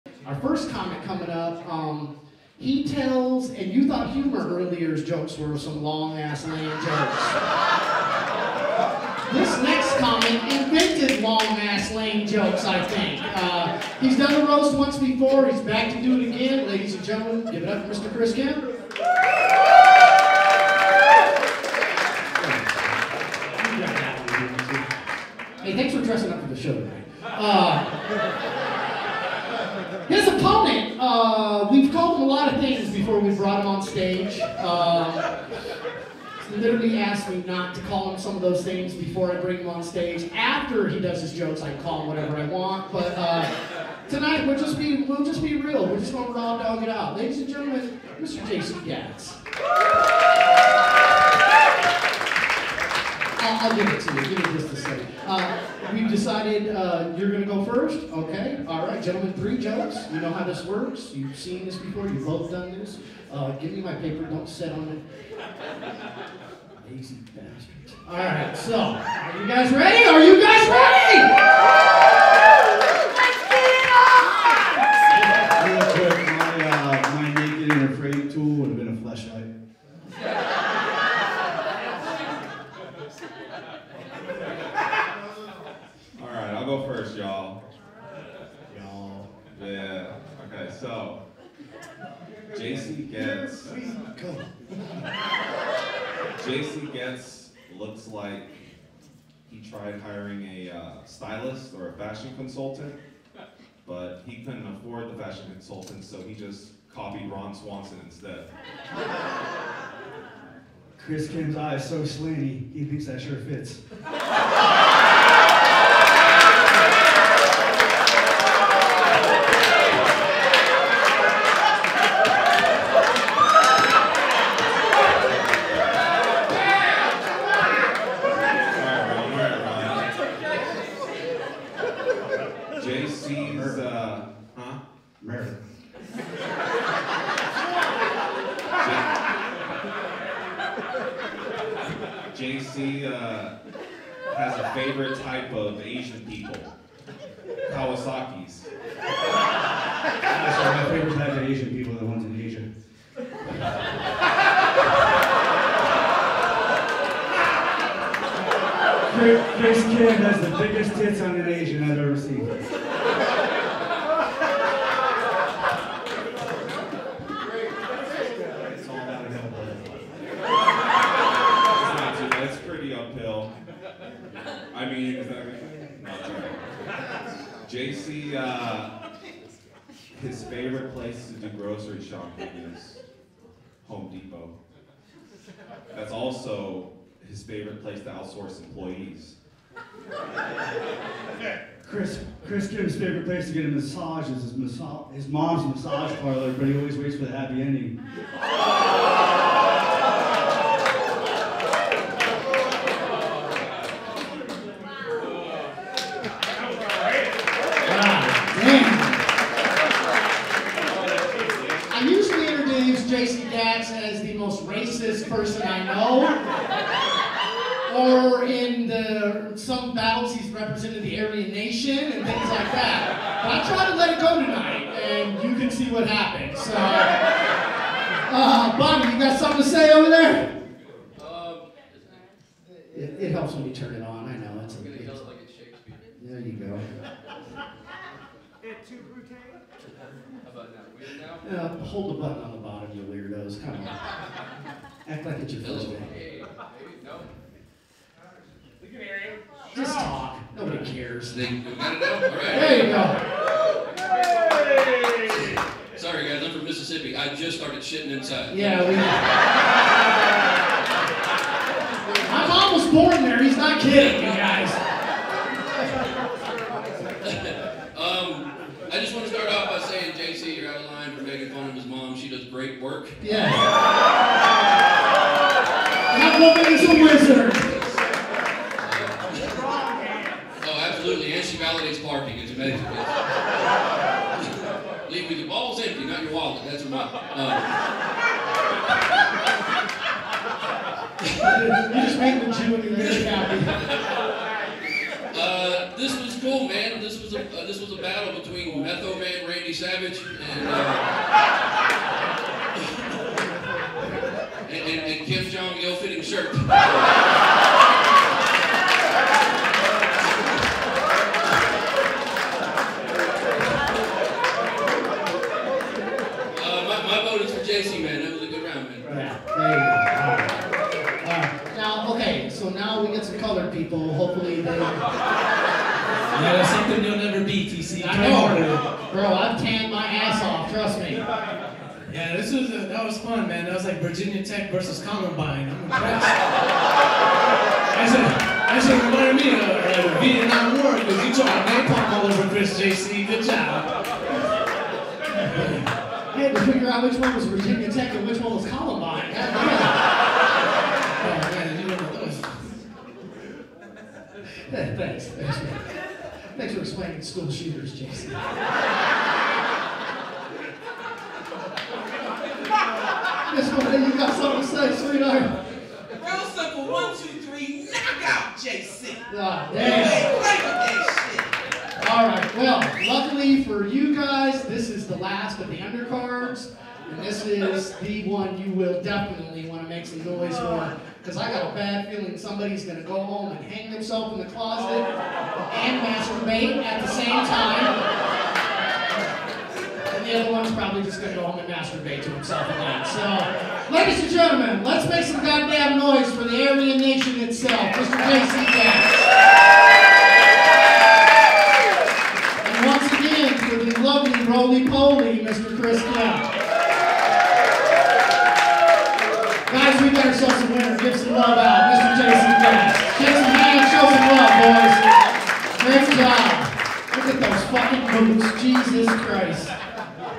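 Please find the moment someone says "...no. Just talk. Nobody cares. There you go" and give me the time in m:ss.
4:07.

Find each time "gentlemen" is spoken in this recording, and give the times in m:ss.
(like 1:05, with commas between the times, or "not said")
0:17, 0:47, 0:59, 6:34.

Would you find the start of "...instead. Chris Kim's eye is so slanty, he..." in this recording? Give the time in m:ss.
1:48.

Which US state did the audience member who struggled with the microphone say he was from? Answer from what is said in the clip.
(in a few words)
Mississippi.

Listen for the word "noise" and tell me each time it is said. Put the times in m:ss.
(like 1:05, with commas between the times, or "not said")
6:20, 6:35.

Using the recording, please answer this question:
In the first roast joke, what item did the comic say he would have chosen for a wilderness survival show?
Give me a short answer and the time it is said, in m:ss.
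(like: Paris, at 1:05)
a flashlight, at 1:18.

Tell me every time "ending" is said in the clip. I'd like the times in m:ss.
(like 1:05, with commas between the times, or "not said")
3:17.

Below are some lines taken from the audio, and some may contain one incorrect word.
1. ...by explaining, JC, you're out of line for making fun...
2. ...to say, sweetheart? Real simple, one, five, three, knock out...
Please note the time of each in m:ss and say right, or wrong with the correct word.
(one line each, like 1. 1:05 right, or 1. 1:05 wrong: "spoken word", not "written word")
1. 4:29 wrong: "saying", not "explaining"
2. 6:04 wrong: "two", not "five".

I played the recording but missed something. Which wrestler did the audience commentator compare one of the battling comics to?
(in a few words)
Macho Man Randy Savage.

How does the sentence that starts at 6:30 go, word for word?
And the other one's probably just going to go home and masturbate to himself again.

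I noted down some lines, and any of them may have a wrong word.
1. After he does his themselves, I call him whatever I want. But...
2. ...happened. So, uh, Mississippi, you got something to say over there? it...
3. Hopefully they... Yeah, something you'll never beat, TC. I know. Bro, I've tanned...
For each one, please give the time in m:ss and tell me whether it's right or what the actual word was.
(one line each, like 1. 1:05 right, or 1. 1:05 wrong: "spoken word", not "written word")
1. 0:40 wrong: "jokes", not "themselves"
2. 3:46 wrong: "Bobby", not "Mississippi"
3. 5:24 right.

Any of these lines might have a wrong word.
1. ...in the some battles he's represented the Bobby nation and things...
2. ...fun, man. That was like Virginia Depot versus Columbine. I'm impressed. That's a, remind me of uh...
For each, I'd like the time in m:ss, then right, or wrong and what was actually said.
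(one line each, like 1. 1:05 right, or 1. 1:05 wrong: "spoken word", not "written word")
1. 3:38 wrong: "Aryan", not "Bobby"
2. 5:33 wrong: "Tech", not "Depot".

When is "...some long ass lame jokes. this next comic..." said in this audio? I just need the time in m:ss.
0:05.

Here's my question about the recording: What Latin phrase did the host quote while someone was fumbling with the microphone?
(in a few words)
Et tu, Brute.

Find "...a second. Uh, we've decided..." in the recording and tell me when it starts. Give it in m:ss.
0:54.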